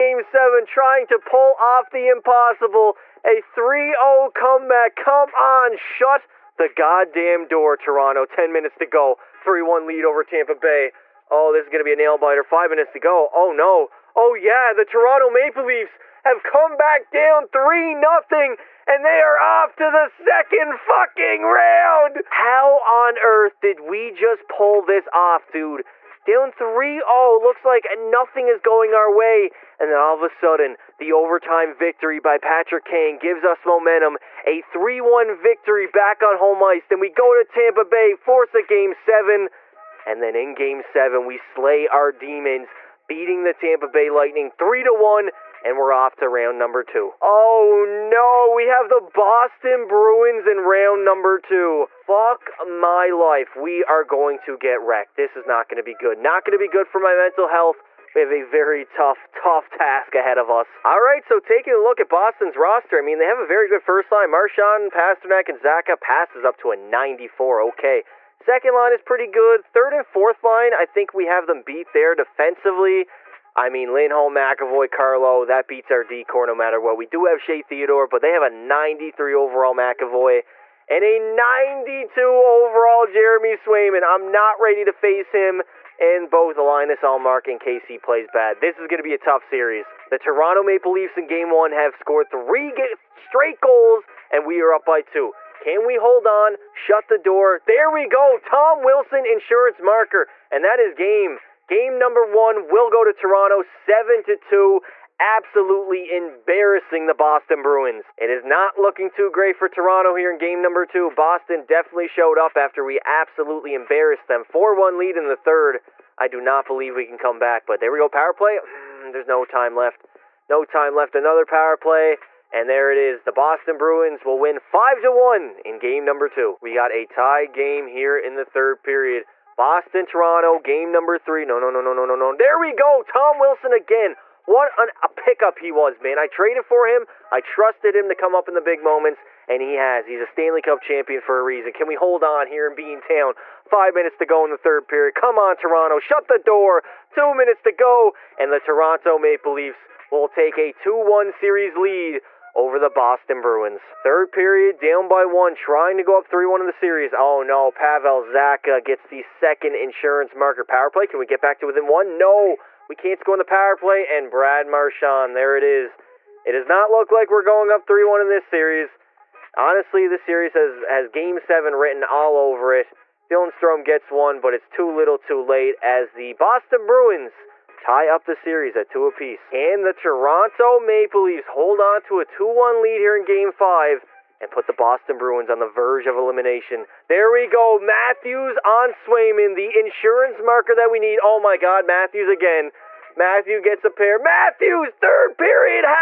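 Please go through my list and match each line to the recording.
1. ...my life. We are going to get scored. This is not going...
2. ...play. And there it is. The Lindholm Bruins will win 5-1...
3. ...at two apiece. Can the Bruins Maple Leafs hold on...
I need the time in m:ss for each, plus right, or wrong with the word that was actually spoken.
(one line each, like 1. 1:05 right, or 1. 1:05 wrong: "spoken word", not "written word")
1. 0:52 wrong: "wrecked", not "scored"
2. 2:01 wrong: "Boston", not "Lindholm"
3. 2:58 wrong: "Toronto", not "Bruins".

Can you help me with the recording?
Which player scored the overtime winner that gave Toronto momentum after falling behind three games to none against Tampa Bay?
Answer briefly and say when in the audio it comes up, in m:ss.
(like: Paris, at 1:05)
Patrick Kane, at 0:32.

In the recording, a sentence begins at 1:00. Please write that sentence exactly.
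All right, so taking a look at Boston's roster, I mean, they have a very good first line.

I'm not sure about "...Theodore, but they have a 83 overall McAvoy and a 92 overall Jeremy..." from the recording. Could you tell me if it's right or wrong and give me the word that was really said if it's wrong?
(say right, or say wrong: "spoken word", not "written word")
wrong: "93", not "83".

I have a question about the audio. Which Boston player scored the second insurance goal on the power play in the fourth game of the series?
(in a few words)
Pavel Zacha.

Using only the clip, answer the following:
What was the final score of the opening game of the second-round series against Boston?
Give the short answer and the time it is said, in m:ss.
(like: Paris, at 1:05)
7 to 2, at 1:43.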